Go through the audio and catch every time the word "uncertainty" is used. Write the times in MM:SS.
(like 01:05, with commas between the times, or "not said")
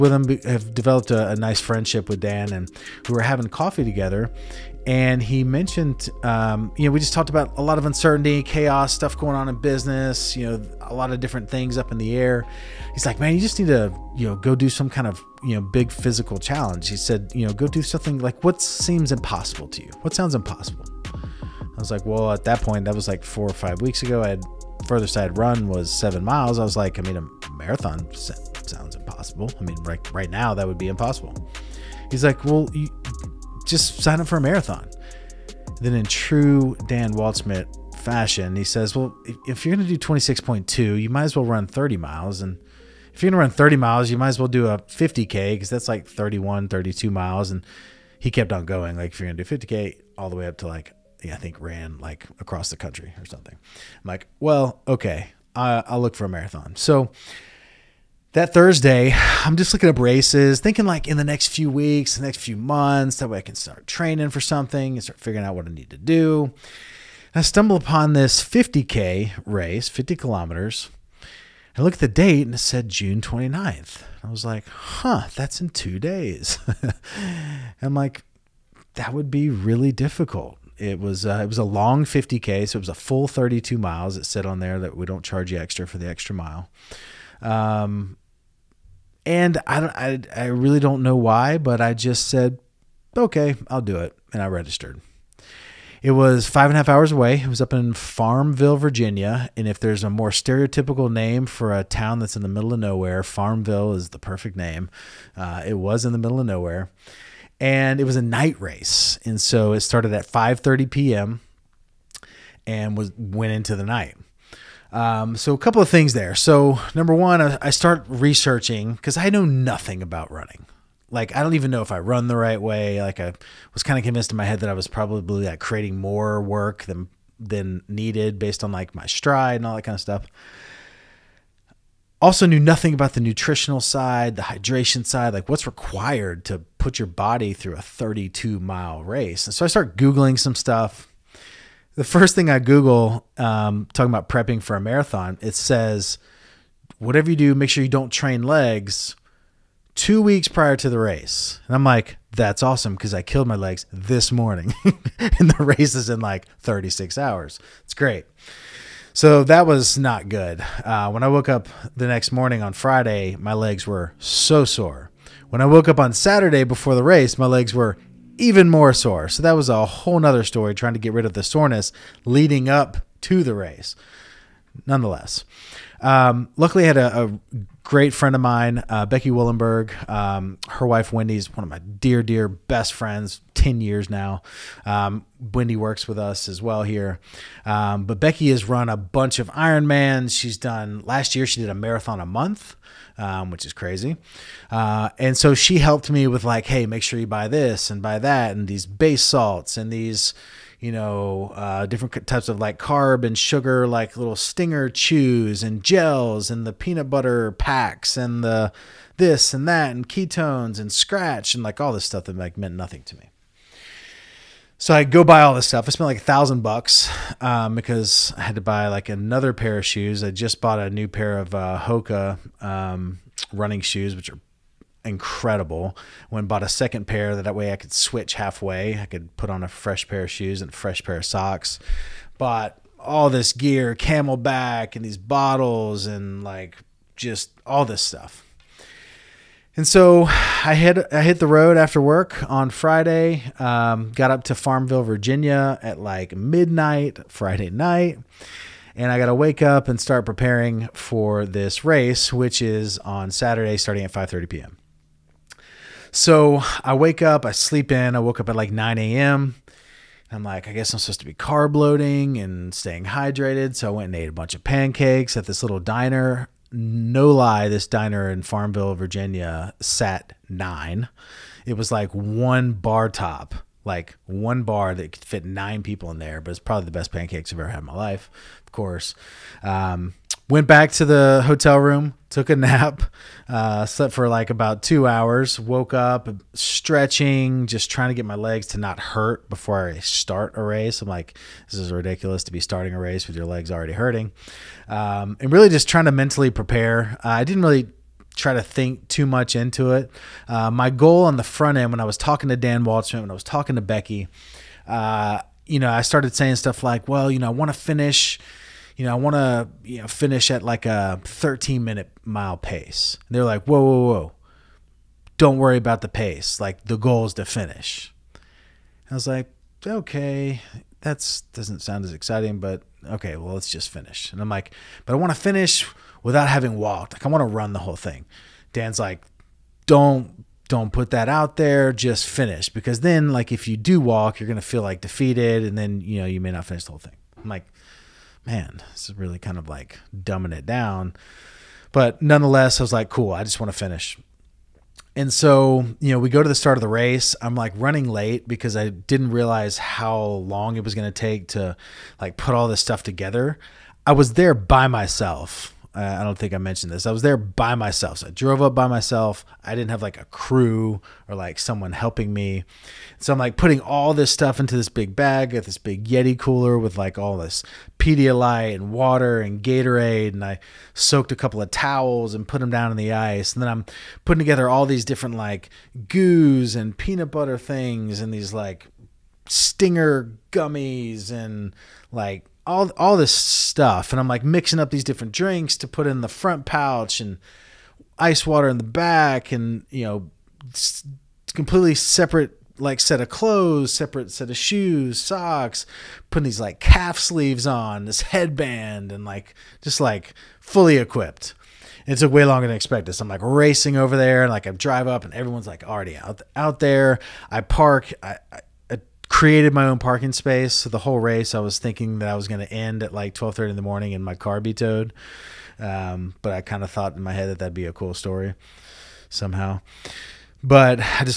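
00:07.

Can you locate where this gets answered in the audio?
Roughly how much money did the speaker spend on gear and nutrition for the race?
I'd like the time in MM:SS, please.
03:36.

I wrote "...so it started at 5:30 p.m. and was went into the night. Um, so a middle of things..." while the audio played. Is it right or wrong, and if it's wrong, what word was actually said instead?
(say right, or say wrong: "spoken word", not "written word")
wrong: "couple", not "middle".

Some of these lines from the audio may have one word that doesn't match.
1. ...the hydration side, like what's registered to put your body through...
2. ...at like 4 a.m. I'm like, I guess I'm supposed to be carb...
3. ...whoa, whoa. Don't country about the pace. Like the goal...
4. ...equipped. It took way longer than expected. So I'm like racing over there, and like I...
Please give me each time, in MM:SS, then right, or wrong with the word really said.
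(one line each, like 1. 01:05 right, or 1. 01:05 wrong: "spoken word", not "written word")
1. 02:14 wrong: "required", not "registered"
2. 04:18 wrong: "9", not "4"
3. 05:13 wrong: "worry", not "country"
4. 06:40 right.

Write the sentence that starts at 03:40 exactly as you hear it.
I just bought a new pair of uh, Hoka um, running shoes, which are incredible.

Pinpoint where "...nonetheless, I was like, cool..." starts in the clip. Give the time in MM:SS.
05:42.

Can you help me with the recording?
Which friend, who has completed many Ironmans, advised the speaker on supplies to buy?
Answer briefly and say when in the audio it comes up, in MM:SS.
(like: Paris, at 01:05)
Becky Willenberg, at 02:59.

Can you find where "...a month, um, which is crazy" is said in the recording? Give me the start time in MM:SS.
03:12.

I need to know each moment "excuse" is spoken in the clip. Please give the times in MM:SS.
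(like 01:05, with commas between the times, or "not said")
not said.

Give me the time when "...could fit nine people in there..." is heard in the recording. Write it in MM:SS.
04:35.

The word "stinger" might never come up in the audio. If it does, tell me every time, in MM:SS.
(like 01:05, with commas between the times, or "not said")
03:24, 06:19.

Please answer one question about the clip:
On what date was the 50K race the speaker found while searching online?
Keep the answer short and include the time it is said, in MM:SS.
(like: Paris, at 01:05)
June 29th, at 01:12.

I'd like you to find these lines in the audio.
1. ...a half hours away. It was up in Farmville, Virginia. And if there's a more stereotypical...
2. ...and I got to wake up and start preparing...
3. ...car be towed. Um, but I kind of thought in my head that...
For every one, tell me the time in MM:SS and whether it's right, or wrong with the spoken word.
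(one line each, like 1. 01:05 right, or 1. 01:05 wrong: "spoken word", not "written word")
1. 01:36 right
2. 04:08 right
3. 06:54 right.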